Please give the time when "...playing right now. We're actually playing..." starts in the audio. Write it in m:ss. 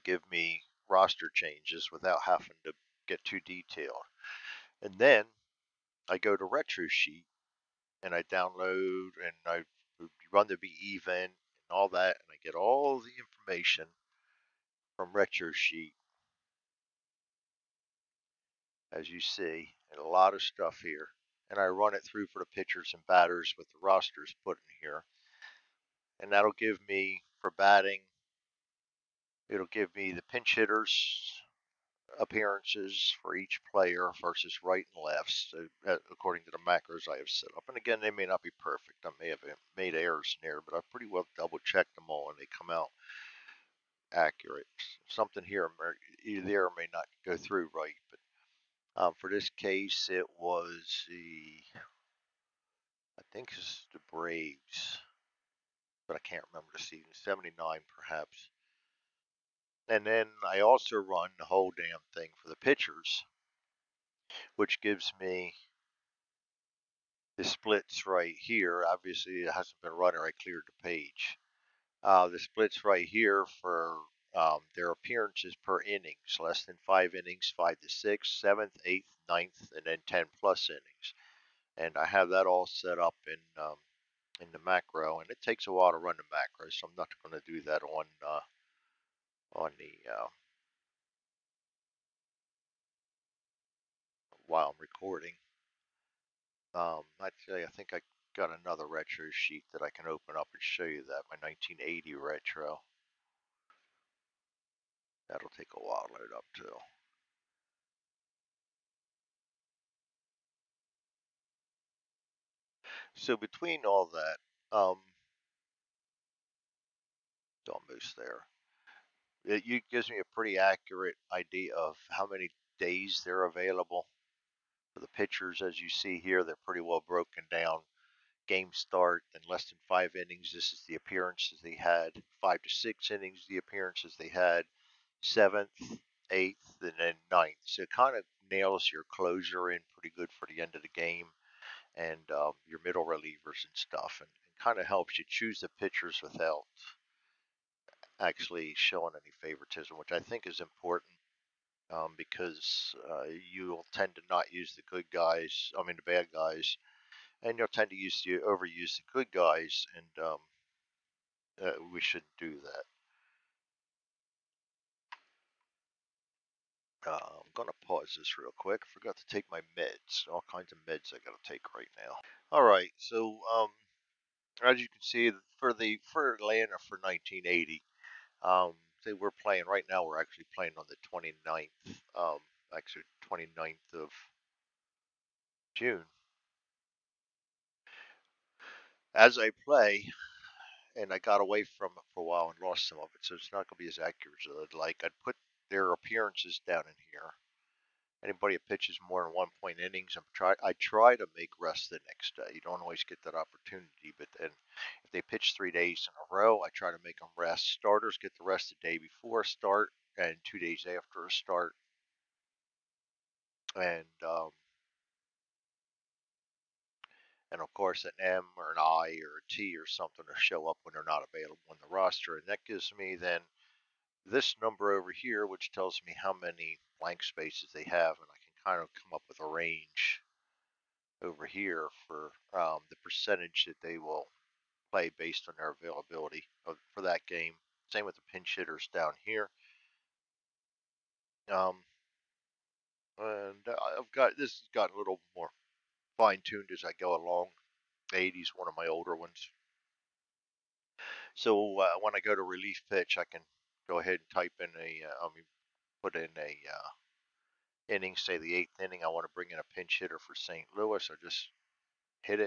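2:59.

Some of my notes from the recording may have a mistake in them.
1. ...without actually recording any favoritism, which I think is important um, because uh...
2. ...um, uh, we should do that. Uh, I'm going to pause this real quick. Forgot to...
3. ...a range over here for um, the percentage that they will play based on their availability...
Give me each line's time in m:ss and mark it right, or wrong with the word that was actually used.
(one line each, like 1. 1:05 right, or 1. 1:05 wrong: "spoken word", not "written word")
1. 2:26 wrong: "showing", not "recording"
2. 2:40 right
3. 3:49 right.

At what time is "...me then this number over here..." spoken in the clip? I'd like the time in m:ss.
3:42.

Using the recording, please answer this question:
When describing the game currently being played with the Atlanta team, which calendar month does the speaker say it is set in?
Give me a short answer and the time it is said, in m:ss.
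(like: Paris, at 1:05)
June, at 3:05.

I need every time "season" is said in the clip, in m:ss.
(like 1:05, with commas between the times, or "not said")
0:56.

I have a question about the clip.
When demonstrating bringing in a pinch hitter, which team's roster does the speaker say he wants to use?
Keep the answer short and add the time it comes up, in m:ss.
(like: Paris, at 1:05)
St. Louis, at 4:20.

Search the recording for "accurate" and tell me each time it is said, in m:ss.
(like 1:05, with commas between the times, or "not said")
0:44, 2:00, 3:13.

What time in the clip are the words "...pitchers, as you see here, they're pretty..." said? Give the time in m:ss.
2:05.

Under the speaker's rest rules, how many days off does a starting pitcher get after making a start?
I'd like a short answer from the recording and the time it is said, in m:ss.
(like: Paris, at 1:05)
2, at 3:30.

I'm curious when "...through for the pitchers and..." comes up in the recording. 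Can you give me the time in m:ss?
0:22.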